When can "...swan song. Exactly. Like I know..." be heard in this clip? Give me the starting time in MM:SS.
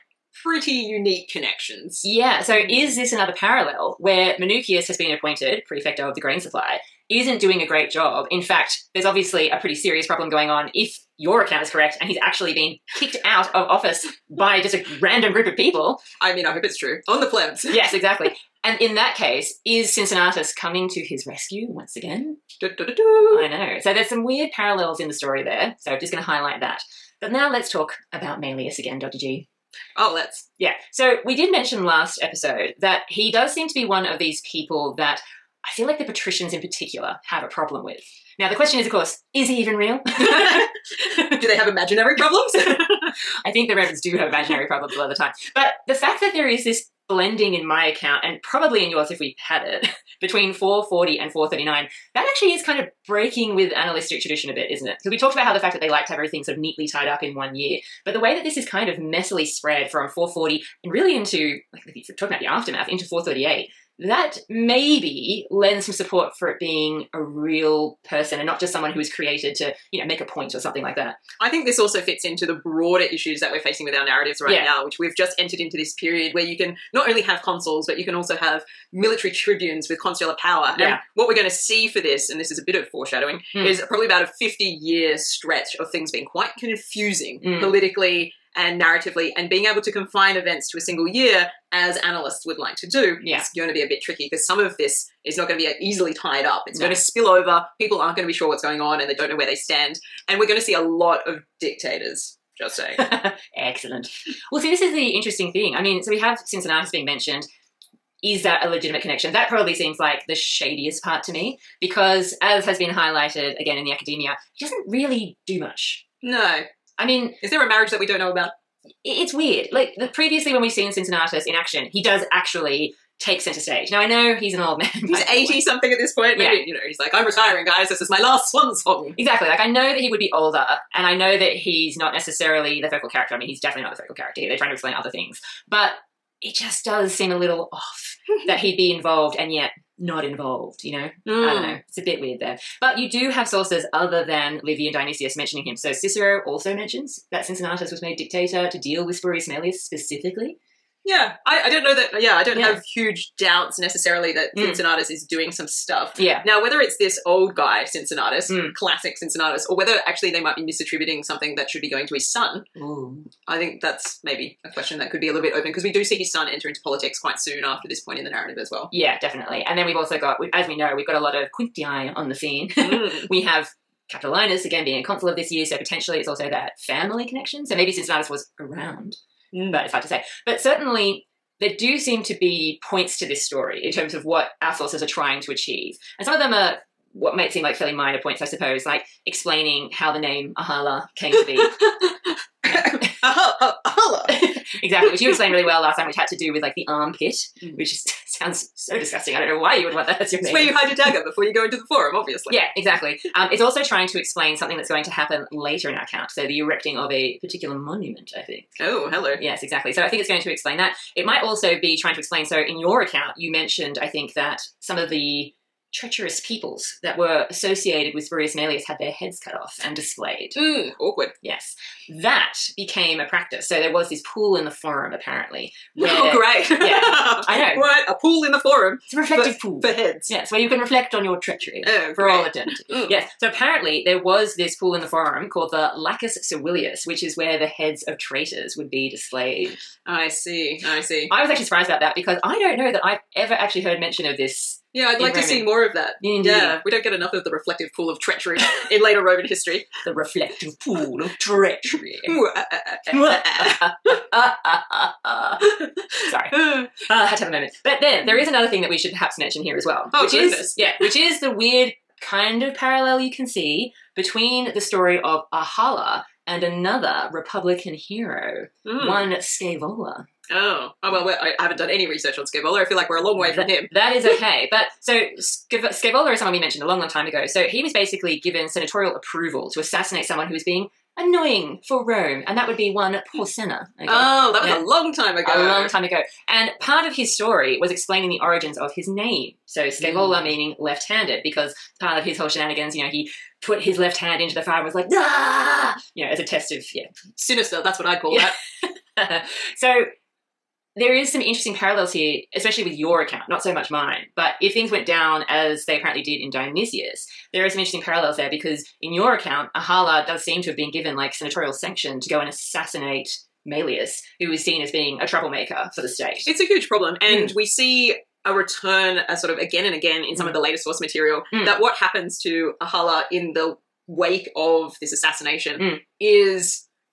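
02:08.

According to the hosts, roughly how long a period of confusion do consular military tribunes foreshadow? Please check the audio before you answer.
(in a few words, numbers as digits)
50 years.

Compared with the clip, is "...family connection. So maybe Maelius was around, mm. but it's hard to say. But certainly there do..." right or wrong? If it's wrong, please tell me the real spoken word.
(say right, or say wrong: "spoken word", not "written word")
wrong: "Cincinnatus", not "Maelius".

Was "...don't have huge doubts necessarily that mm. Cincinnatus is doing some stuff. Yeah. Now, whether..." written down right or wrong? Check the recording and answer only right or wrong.
right.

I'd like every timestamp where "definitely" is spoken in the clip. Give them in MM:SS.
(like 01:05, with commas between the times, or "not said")
02:13, 02:49.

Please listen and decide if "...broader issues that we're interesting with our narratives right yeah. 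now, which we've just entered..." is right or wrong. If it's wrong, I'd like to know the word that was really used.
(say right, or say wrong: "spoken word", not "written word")
wrong: "facing", not "interesting".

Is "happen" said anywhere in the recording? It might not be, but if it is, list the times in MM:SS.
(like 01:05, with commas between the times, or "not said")
03:25, 05:21.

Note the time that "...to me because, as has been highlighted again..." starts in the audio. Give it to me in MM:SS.
01:51.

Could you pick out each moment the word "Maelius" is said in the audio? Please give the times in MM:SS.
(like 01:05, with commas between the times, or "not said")
00:28, 02:29, 03:38, 05:13.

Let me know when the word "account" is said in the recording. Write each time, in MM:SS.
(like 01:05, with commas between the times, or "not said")
00:11, 00:47, 03:26, 03:32, 05:03, 05:09.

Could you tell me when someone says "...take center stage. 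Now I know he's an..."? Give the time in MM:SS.
02:03.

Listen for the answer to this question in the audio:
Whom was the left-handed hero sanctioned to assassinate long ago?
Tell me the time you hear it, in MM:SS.
04:43.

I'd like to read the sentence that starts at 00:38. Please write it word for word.
Now, the question is, of course, is he even real?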